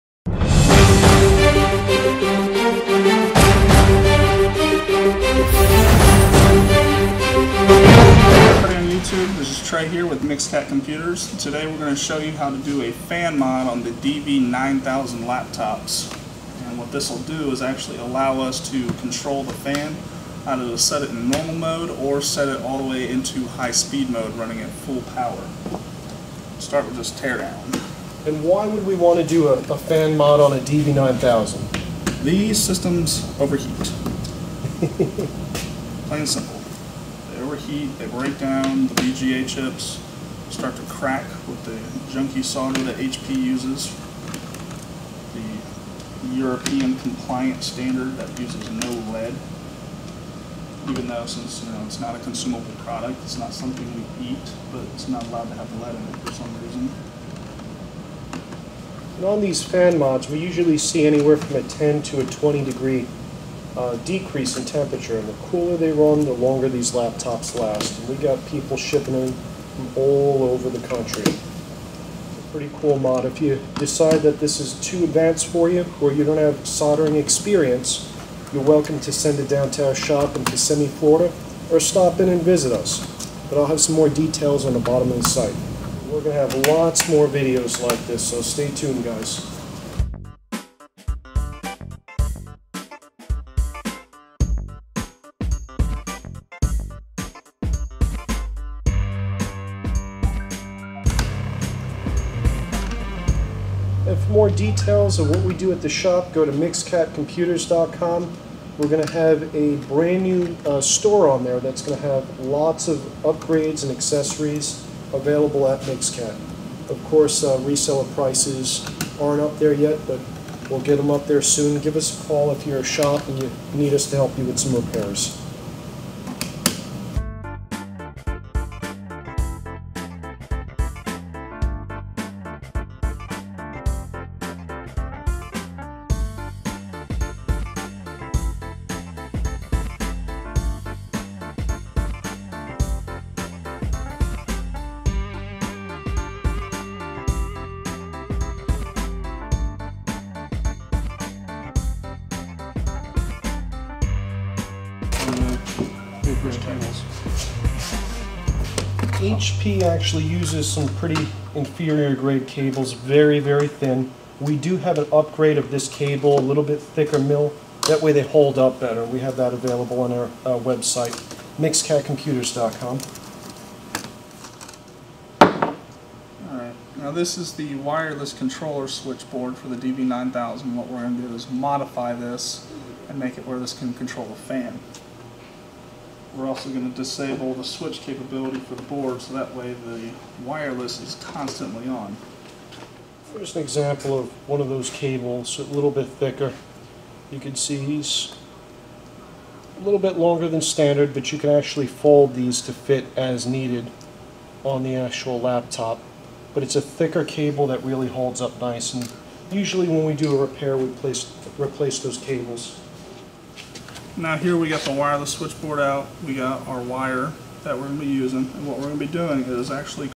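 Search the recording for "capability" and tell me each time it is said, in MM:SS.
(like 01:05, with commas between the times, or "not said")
03:08.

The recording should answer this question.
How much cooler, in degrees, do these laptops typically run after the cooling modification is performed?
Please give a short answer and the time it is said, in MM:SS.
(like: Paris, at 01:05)
10 to 20 degrees, at 01:01.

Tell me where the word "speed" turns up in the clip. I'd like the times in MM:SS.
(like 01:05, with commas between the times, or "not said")
00:23.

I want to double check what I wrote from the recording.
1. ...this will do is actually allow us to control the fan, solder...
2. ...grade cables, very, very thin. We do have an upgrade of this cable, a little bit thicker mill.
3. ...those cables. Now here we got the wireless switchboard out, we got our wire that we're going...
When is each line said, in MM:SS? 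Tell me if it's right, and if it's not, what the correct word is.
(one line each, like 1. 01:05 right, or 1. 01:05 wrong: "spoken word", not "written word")
1. 00:16 wrong: "either", not "solder"
2. 02:42 right
3. 03:31 right.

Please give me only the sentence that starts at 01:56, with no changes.
Of course, uh, reseller prices aren't up there yet, but we'll get them up there soon.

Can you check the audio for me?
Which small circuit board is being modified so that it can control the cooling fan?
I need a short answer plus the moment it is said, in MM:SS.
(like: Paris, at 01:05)
wireless controller switchboard, at 02:57.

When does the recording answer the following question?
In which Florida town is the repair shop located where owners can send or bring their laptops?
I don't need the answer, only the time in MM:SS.
01:20.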